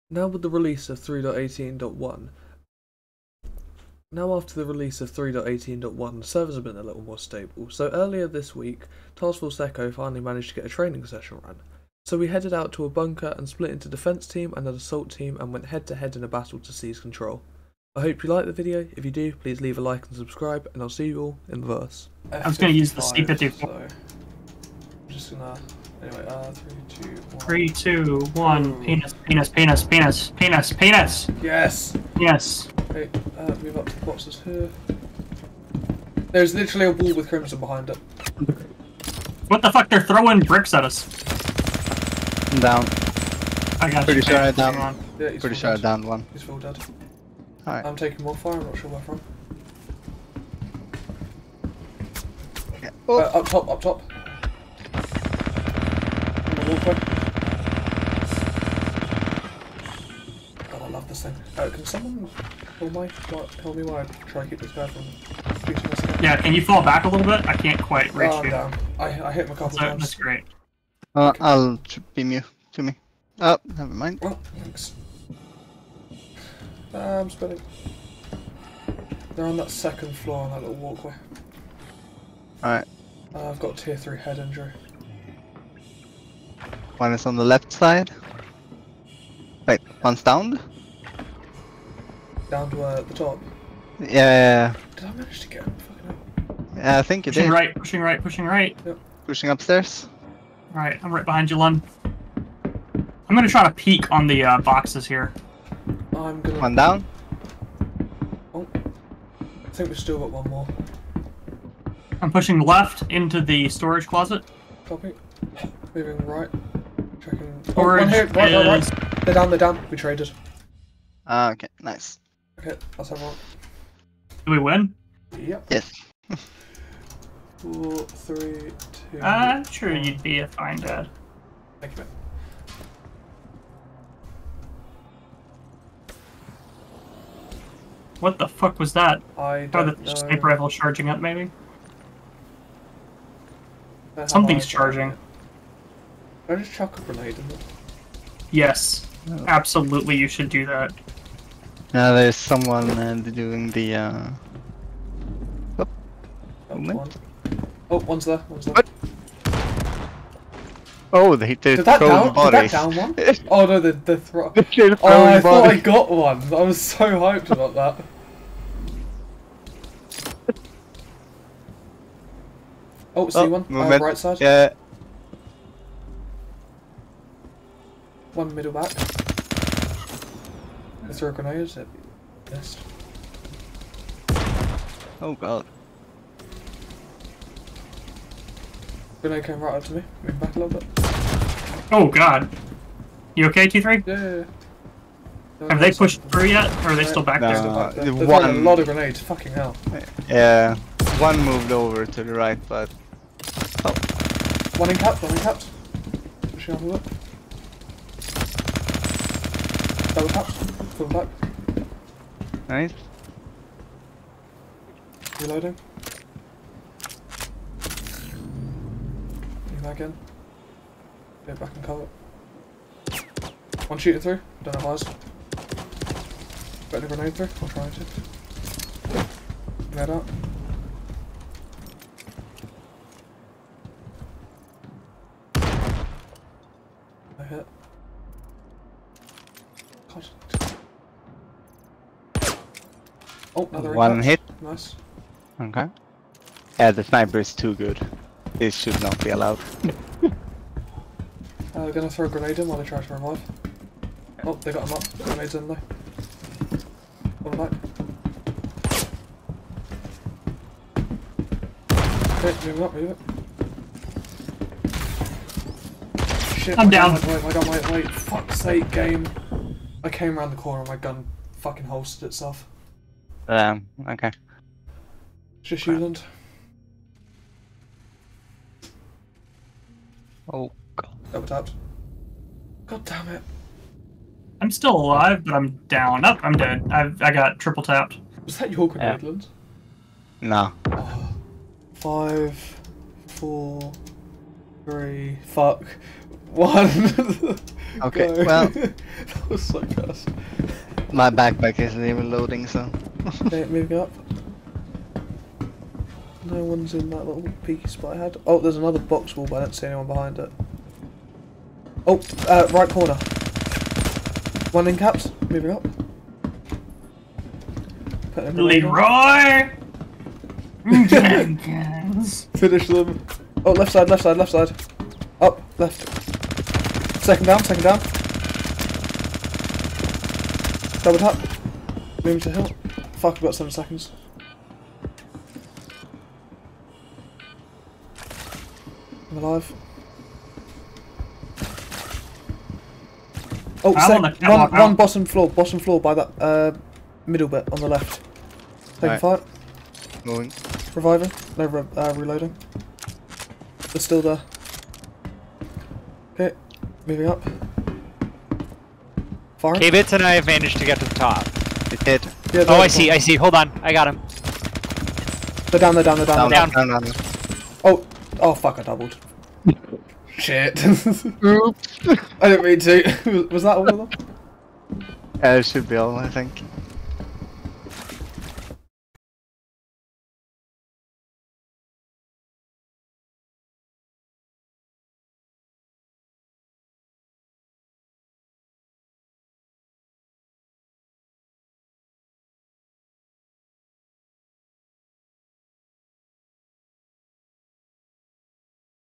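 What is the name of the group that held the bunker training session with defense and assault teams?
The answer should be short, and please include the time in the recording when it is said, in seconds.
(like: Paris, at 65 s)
Task Force Echo, at 9 s.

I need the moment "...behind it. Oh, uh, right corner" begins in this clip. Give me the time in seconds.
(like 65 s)
310 s.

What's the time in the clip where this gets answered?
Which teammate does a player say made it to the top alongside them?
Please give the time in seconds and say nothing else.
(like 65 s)
359 s.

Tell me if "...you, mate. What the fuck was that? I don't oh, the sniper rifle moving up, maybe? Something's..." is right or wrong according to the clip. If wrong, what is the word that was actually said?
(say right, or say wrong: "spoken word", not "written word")
wrong: "charging", not "moving".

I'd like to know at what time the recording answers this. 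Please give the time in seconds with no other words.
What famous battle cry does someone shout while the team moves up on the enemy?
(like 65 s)
318 s.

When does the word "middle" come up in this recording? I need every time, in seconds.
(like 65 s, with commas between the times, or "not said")
178 s, 347 s.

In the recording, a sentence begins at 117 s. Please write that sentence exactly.
Oh, Orange one right, right, right.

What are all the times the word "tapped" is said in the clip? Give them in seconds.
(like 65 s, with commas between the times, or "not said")
281 s, 287 s.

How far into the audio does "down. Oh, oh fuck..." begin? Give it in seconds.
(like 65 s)
367 s.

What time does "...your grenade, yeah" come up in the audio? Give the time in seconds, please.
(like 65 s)
288 s.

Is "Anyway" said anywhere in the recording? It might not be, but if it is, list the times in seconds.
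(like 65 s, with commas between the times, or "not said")
26 s.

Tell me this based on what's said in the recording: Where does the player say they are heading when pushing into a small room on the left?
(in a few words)
storage closet.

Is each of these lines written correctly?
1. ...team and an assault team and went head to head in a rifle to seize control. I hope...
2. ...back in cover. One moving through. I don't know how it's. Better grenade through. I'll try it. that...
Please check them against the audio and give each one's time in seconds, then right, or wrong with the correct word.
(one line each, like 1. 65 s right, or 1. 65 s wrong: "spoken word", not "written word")
1. 14 s wrong: "battle", not "rifle"
2. 221 s wrong: "shooting", not "moving".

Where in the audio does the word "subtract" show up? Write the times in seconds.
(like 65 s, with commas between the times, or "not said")
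not said.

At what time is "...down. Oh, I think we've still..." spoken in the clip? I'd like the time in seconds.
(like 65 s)
106 s.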